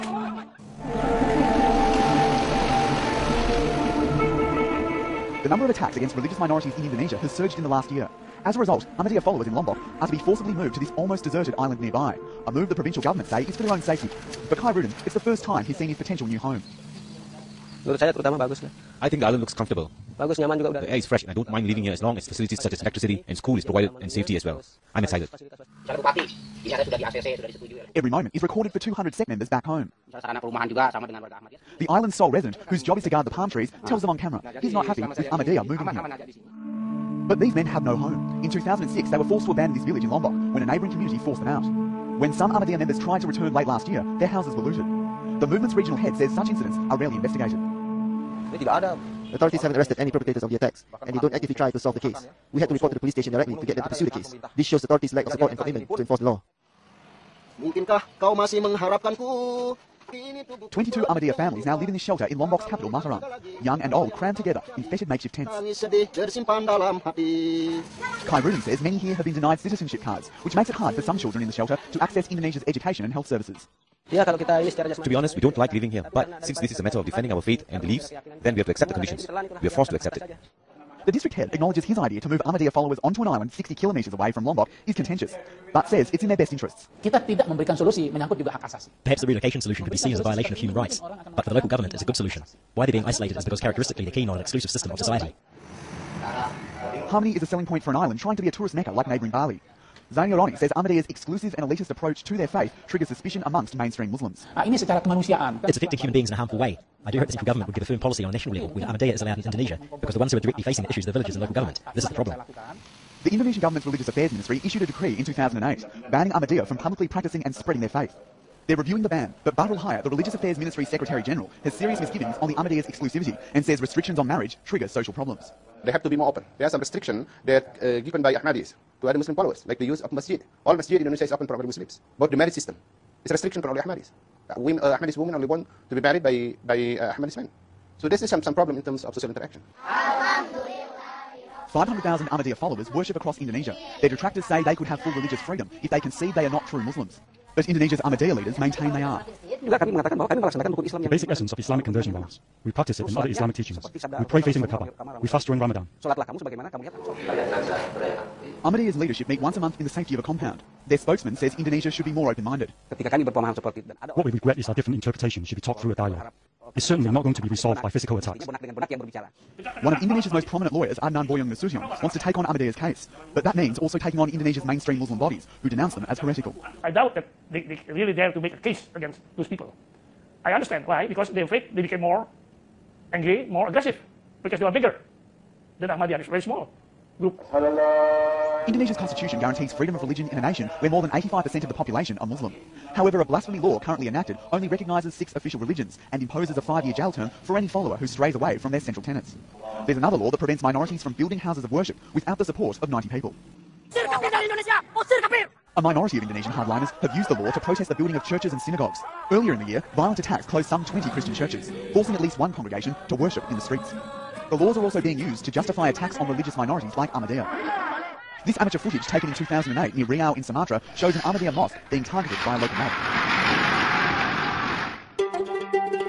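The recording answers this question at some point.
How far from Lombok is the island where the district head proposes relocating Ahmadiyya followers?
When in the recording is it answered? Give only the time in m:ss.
1:23.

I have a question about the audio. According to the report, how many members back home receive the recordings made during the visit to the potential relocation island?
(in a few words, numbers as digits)
200.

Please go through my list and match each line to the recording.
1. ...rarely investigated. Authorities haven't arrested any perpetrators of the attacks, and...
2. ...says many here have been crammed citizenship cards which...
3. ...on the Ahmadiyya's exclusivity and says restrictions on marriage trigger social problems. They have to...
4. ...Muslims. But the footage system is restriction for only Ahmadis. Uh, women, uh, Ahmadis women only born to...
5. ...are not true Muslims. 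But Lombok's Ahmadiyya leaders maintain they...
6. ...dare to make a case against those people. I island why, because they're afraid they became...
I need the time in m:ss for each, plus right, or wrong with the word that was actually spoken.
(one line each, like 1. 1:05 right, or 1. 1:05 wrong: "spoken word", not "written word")
1. 0:46 right
2. 1:08 wrong: "denied", not "crammed"
3. 2:02 right
4. 2:11 wrong: "marriage", not "footage"
5. 2:26 wrong: "Indonesia", not "Lombok"
6. 2:58 wrong: "understand", not "island".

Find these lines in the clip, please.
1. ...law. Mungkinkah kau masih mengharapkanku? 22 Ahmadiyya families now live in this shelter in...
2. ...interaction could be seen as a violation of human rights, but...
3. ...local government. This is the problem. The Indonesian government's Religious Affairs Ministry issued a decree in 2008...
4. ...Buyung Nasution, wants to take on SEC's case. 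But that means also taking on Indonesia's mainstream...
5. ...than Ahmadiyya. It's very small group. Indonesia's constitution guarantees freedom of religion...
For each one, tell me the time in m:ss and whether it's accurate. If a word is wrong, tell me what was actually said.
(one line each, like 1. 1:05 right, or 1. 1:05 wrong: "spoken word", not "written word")
1. 0:56 right
2. 1:29 wrong: "solution", not "interaction"
3. 1:51 right
4. 2:51 wrong: "Ahmadiyya", not "SEC"
5. 3:05 right.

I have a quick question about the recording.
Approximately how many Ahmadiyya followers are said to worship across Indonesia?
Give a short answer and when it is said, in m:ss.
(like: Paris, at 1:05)
500,000, at 2:19.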